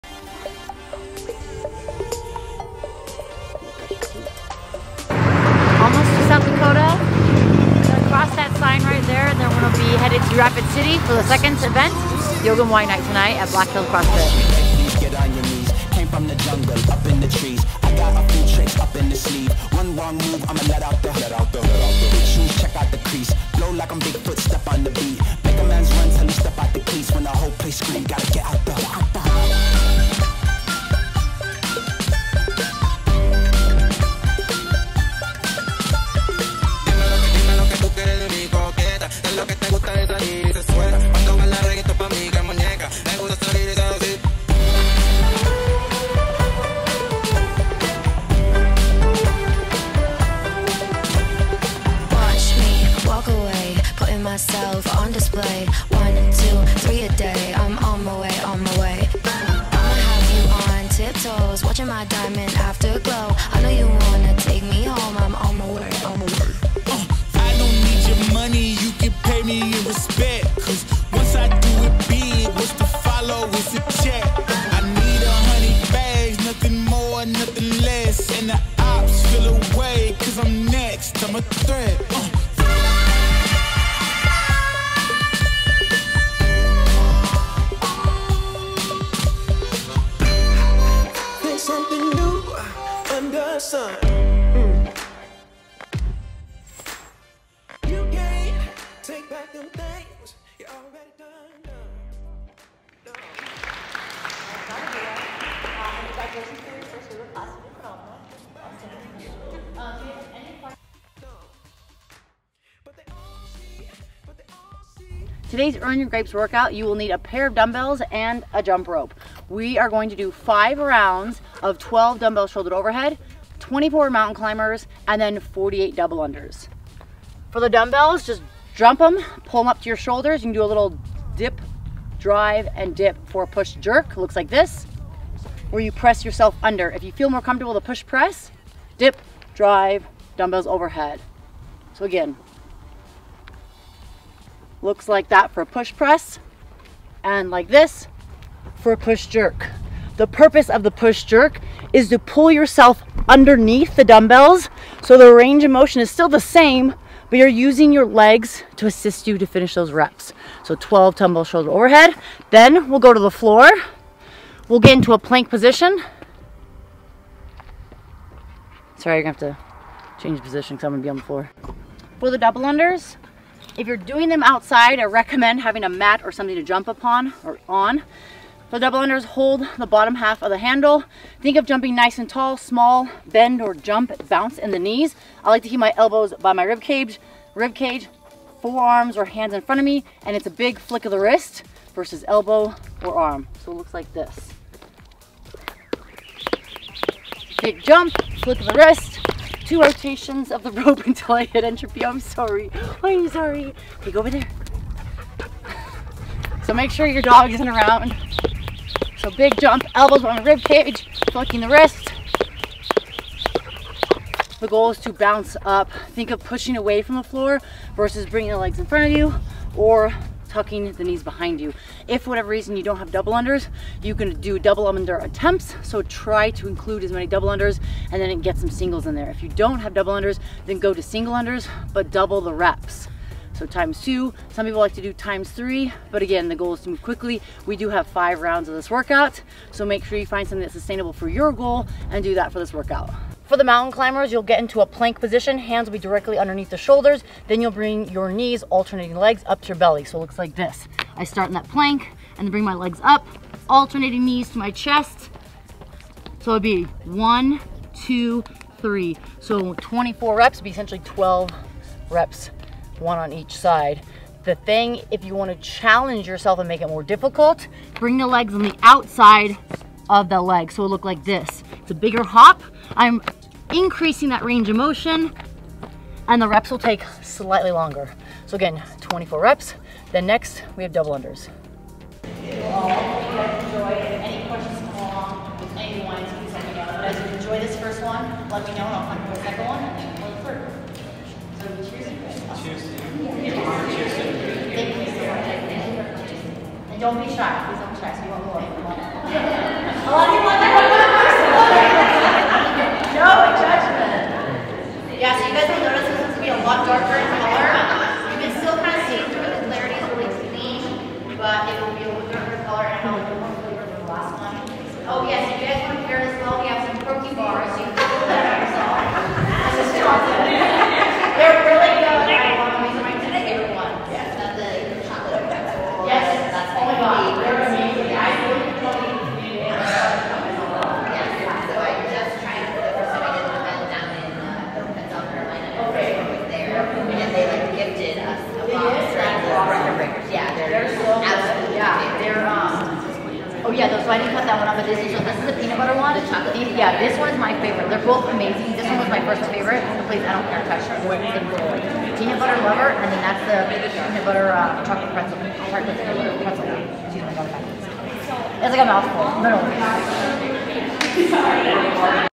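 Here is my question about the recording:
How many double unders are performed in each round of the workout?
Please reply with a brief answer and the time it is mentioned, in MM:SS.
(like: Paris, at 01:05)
48, at 02:05.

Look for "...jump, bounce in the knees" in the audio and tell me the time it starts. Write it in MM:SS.
03:03.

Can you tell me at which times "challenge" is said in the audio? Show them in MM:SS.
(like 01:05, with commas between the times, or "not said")
04:25.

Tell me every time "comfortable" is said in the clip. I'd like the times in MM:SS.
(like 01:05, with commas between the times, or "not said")
02:17.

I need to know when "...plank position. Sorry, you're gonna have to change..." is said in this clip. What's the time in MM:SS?
02:45.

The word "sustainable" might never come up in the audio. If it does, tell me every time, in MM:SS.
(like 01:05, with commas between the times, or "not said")
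04:00.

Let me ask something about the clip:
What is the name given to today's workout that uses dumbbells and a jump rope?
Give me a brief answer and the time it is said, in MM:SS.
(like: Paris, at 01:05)
Earn Your Grapes, at 01:55.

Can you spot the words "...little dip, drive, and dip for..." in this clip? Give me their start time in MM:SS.
02:10.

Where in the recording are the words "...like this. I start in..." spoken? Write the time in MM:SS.
04:10.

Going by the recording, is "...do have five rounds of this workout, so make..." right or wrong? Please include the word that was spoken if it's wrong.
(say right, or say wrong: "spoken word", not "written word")
right.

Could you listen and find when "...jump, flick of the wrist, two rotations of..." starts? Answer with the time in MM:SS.
03:17.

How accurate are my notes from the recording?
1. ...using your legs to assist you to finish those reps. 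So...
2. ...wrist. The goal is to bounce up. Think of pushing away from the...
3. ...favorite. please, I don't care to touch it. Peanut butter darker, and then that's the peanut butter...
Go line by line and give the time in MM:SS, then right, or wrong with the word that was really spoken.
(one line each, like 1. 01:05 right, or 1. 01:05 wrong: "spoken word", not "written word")
1. 02:37 right
2. 03:31 right
3. 05:49 wrong: "lover", not "darker".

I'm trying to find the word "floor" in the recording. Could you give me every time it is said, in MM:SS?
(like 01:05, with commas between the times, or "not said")
02:43, 02:51, 03:37.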